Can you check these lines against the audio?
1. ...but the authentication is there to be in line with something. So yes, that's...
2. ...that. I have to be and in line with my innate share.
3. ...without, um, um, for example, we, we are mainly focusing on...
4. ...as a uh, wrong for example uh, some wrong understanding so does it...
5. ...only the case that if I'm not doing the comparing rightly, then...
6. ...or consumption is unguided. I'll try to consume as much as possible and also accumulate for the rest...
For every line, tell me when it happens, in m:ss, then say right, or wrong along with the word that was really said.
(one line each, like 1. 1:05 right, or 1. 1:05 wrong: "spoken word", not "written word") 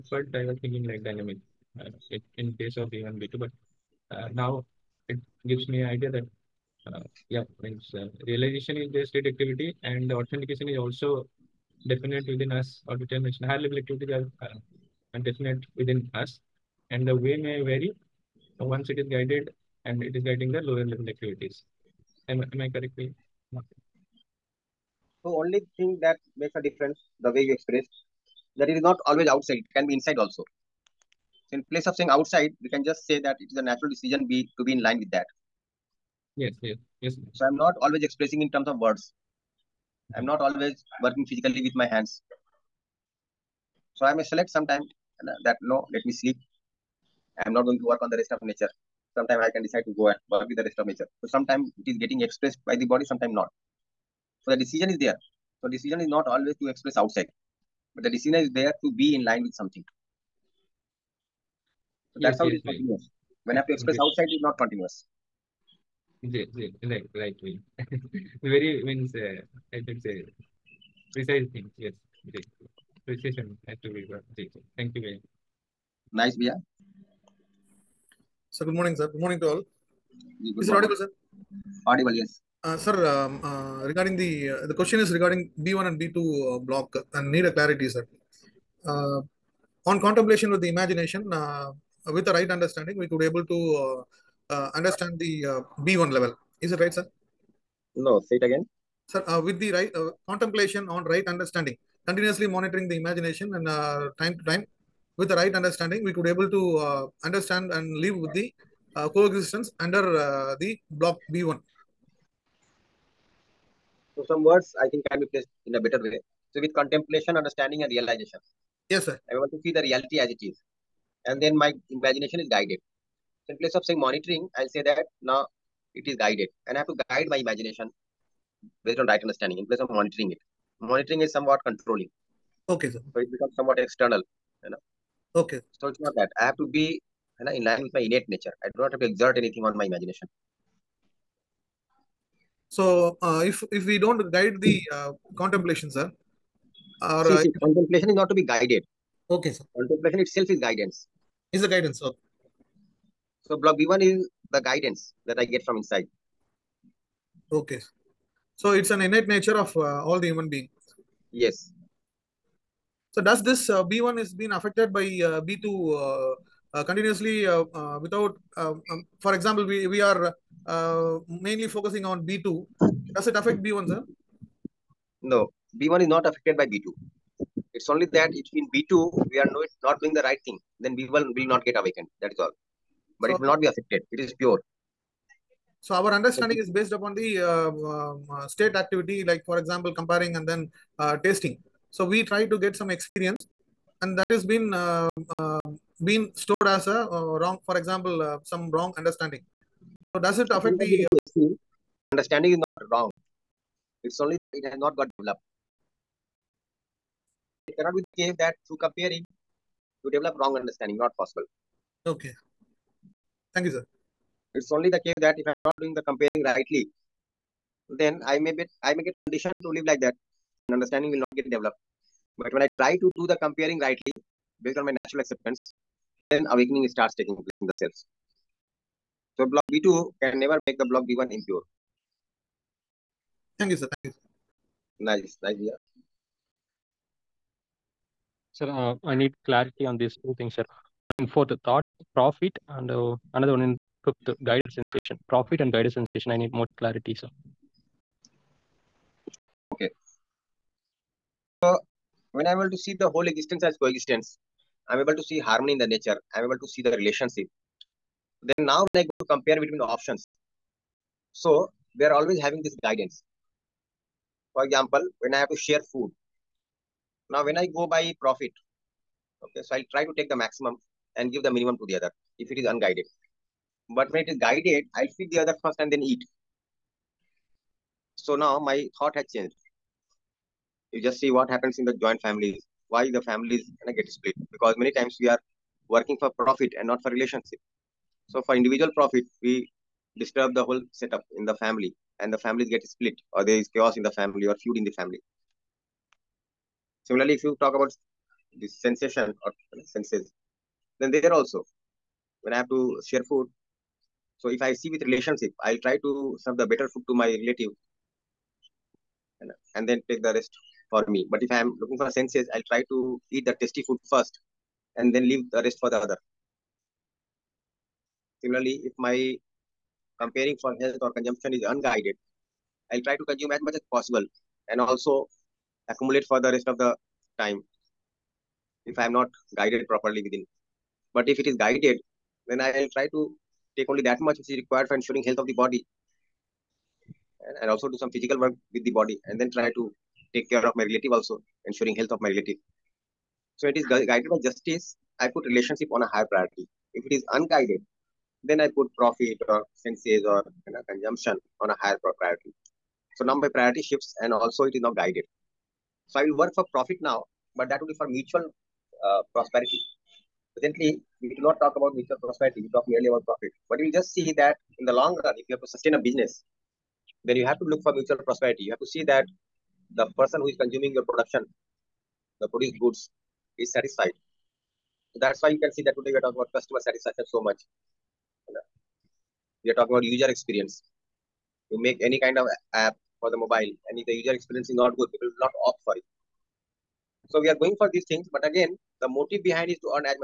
1. 0:57 wrong: "decision", not "authentication"
2. 2:16 wrong: "nature", not "share"
3. 2:47 right
4. 3:16 right
5. 3:34 right
6. 5:21 right.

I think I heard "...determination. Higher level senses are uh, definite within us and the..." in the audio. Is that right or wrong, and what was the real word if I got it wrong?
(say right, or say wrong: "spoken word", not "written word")
wrong: "activities", not "senses".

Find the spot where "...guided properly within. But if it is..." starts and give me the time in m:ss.
5:29.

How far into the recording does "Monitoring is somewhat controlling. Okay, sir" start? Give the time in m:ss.
2:10.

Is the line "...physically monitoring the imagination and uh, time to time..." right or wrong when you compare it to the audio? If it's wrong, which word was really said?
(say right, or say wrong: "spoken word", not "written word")
wrong: "continuously", not "physically".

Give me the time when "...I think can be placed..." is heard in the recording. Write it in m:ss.
1:54.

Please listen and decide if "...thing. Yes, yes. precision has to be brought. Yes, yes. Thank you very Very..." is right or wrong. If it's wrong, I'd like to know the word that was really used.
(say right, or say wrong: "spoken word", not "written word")
wrong: "Nice", not "Very".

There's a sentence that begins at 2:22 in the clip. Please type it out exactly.
So, uh, if if we don't guide the uh, contemplation, sir, or see, uh, see, contemplation is not to be guided.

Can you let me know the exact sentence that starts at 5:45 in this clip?
I put relationship on a higher priority.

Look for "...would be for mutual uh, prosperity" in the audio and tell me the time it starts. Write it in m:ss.
5:57.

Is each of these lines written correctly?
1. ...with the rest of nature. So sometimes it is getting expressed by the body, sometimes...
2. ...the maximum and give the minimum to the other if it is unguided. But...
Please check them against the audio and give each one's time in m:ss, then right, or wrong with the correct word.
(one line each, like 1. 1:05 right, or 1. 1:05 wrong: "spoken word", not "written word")
1. 0:50 right
2. 4:30 right.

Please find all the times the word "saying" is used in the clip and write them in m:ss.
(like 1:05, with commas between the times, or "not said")
0:31, 2:03.